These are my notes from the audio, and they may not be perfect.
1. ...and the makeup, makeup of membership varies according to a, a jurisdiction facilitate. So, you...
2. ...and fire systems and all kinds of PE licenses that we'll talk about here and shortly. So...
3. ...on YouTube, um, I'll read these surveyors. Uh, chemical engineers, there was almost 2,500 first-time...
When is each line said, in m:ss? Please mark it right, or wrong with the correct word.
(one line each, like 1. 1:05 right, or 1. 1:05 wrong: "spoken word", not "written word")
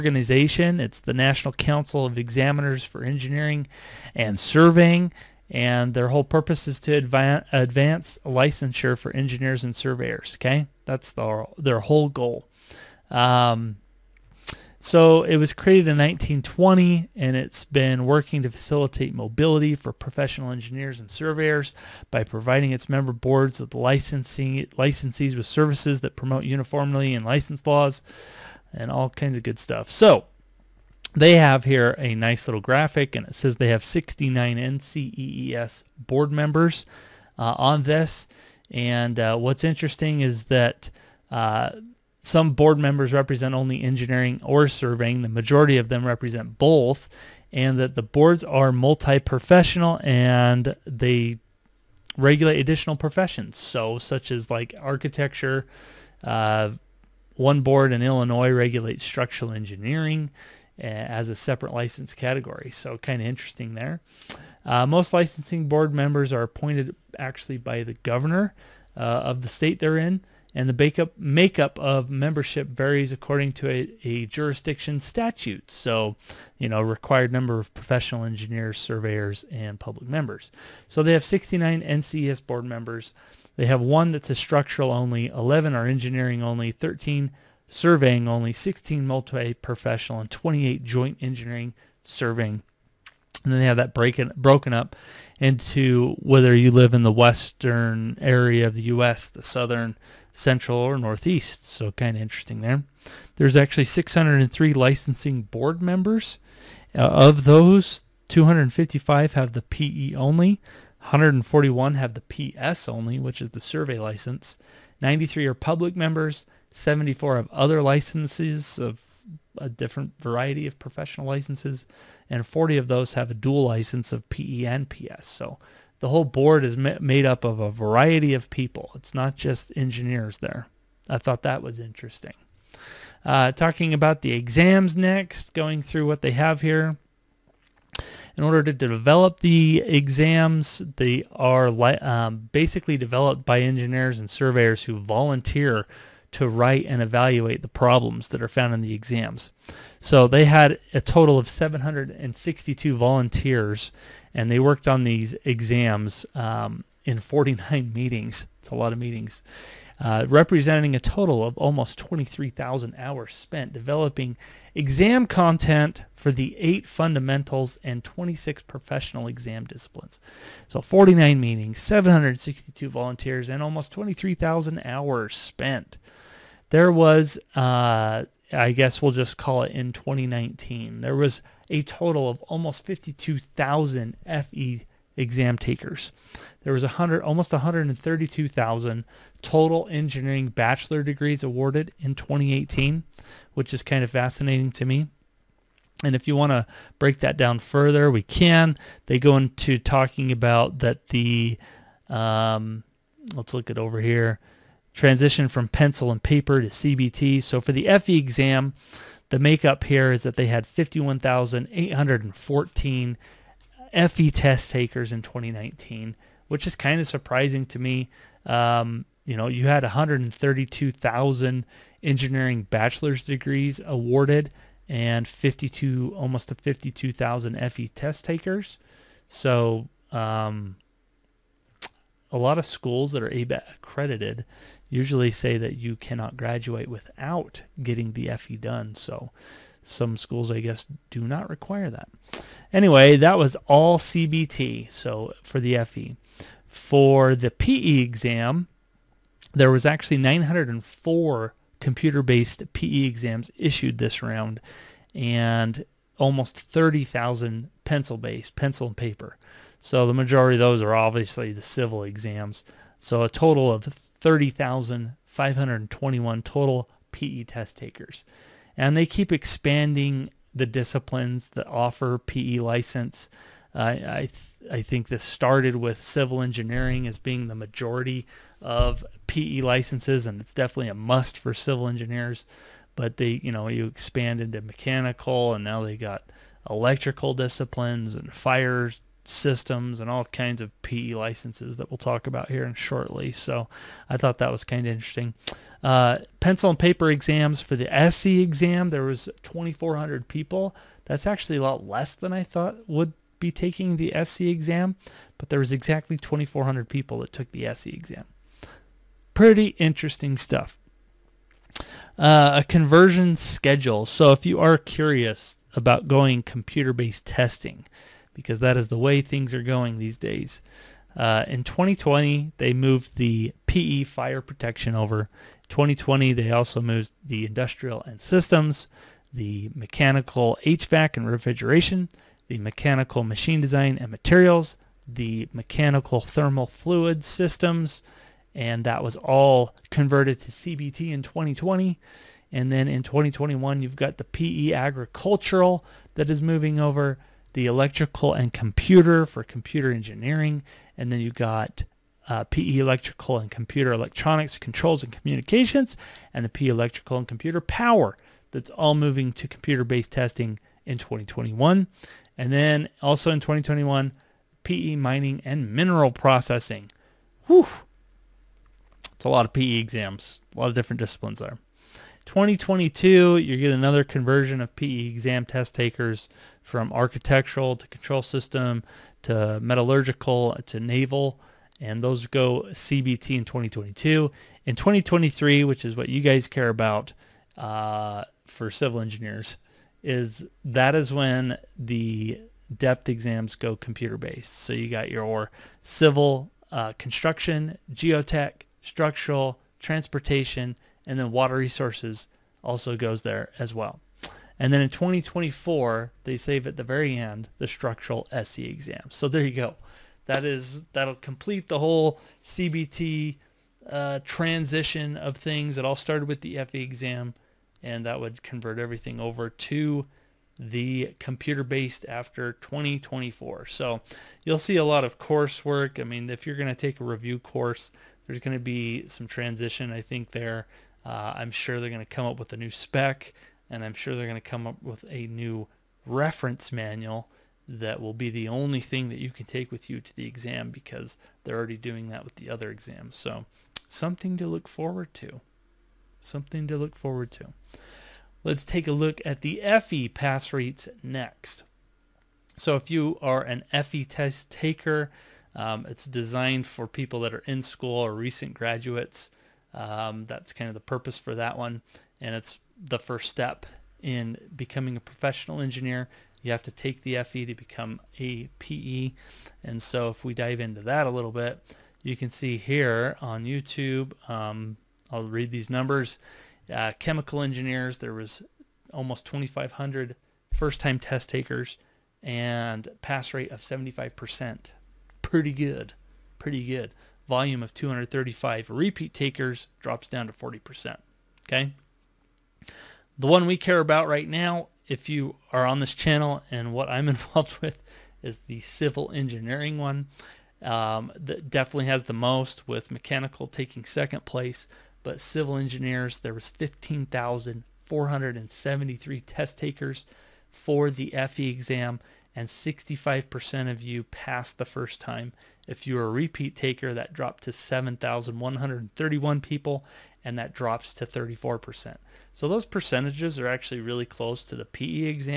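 1. 1:10 wrong: "statute", not "facilitate"
2. 4:48 right
3. 7:53 wrong: "numbers", not "surveyors".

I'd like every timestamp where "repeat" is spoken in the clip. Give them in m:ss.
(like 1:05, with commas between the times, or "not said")
8:08, 8:36.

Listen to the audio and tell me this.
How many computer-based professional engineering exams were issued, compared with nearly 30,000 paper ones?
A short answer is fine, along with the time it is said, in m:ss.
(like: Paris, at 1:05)
904, at 4:10.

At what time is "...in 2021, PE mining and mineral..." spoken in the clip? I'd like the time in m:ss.
6:03.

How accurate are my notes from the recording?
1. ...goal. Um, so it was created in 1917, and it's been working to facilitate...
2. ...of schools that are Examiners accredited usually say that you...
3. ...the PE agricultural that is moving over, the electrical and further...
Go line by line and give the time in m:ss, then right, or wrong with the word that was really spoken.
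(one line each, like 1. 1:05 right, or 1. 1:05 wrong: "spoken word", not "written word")
1. 0:12 wrong: "1920", not "1917"
2. 3:52 wrong: "ABET", not "Examiners"
3. 5:44 wrong: "computer", not "further".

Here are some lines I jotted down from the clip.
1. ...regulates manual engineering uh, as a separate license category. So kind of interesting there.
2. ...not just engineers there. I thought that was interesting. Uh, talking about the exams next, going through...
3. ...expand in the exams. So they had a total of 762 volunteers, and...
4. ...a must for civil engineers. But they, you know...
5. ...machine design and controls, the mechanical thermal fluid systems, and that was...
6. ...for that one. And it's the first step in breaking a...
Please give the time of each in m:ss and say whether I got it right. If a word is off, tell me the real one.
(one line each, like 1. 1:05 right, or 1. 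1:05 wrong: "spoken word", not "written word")
1. 0:58 wrong: "structural", not "manual"
2. 2:09 right
3. 2:28 wrong: "found", not "expand"
4. 4:40 right
5. 5:33 wrong: "materials", not "controls"
6. 7:41 wrong: "becoming", not "breaking".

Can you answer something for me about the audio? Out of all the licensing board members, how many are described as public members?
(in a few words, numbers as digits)
93.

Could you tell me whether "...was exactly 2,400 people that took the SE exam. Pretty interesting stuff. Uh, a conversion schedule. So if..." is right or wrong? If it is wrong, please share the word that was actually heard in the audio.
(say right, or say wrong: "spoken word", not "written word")
right.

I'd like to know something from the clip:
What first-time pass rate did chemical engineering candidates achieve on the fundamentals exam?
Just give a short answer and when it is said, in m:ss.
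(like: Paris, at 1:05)
75%, at 8:03.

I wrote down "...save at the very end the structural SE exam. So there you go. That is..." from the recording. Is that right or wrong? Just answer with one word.
right.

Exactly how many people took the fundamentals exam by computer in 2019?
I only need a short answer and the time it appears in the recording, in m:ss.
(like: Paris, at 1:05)
51,814, at 3:30.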